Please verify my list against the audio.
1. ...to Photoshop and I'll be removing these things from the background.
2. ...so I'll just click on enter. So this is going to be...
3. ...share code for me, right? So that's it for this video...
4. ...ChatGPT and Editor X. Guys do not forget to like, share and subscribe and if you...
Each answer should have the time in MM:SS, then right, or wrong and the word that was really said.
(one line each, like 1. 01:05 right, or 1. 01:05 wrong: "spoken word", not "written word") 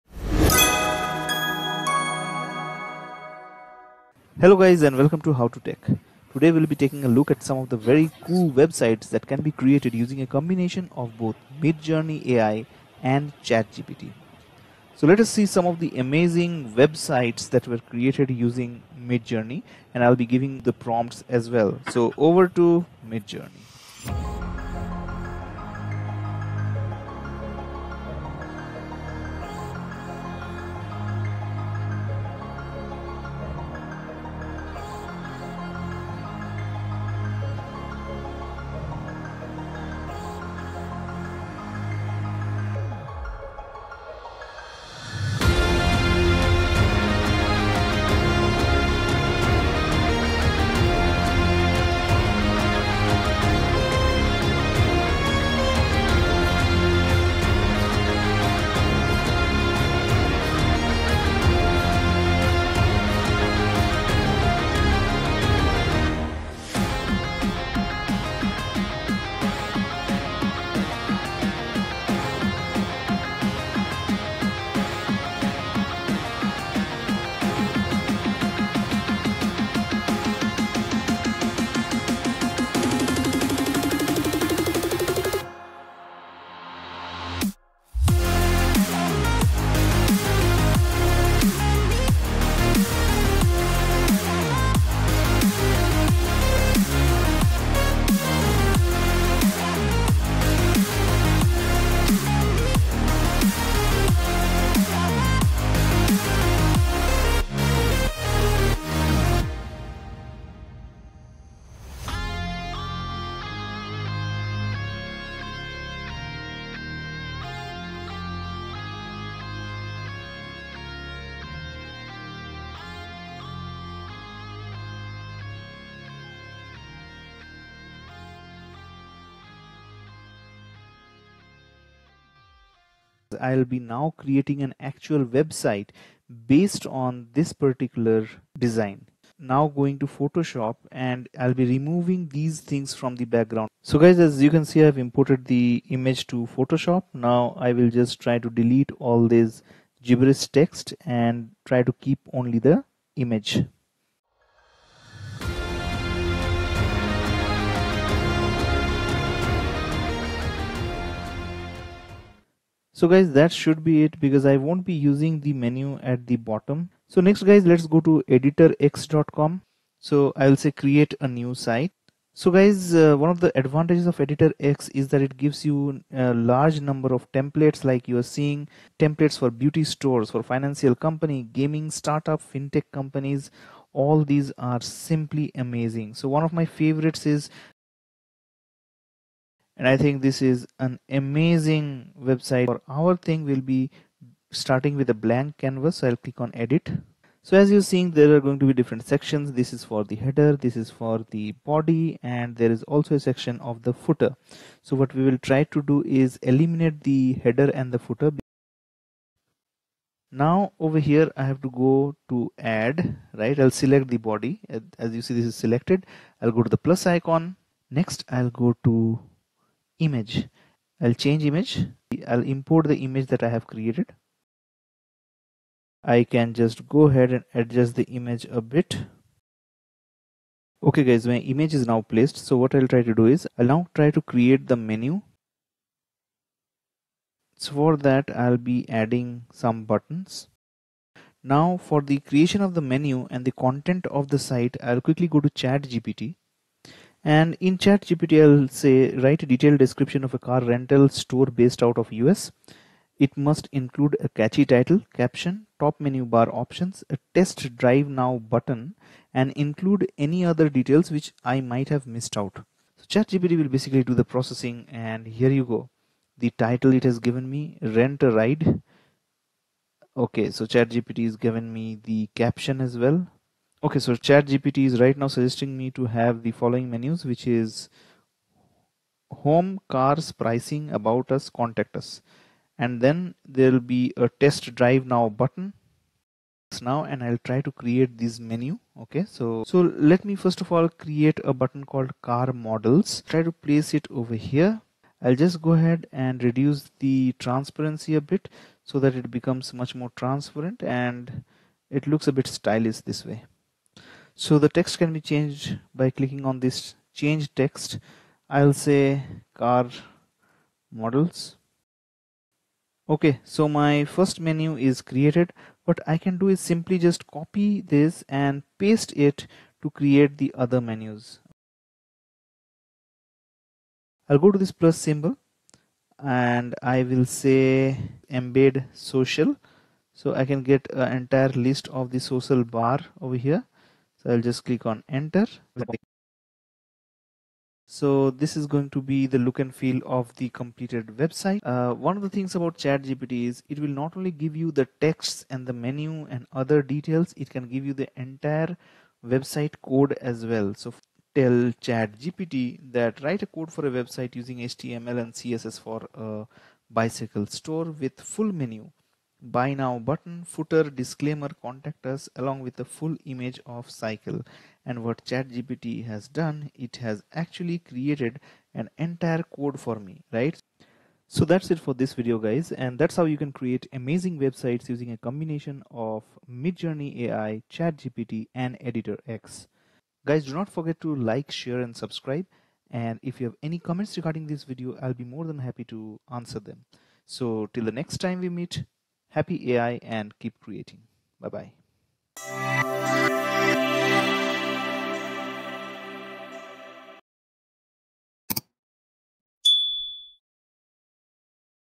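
1. 02:19 right
2. 05:34 right
3. 06:08 wrong: "entire", not "share"
4. 06:17 right.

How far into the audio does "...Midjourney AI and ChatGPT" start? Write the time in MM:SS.
00:11.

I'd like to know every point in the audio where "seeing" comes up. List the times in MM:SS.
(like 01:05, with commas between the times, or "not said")
02:58, 03:17.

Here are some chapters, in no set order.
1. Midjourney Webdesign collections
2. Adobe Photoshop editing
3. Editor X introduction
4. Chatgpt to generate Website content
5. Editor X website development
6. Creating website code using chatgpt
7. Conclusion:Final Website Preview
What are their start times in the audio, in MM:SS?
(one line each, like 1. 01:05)
1. 00:24
2. 02:24
3. 02:49
4. 04:05
5. 04:50
6. 05:40
7. 06:17.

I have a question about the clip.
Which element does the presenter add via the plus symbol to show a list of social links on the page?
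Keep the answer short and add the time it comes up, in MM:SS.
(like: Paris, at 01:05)
Embed social, at 05:28.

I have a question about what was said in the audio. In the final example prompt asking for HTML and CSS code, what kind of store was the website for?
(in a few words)
Bicycle store.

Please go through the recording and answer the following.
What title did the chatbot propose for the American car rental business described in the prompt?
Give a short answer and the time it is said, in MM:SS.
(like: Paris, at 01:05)
Rent a Ride, at 04:27.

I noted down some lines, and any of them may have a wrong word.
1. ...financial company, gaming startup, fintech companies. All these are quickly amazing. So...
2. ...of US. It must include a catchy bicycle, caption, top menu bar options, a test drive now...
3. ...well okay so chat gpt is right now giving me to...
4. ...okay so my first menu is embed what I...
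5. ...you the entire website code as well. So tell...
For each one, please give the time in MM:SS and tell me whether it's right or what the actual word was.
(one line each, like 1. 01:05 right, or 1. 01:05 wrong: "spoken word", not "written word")
1. 03:00 wrong: "simply", not "quickly"
2. 04:11 wrong: "title", not "bicycle"
3. 04:32 wrong: "suggesting", not "giving"
4. 05:13 wrong: "created", not "embed"
5. 05:47 right.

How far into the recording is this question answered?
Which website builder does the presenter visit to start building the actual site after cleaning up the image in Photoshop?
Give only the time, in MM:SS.
02:48.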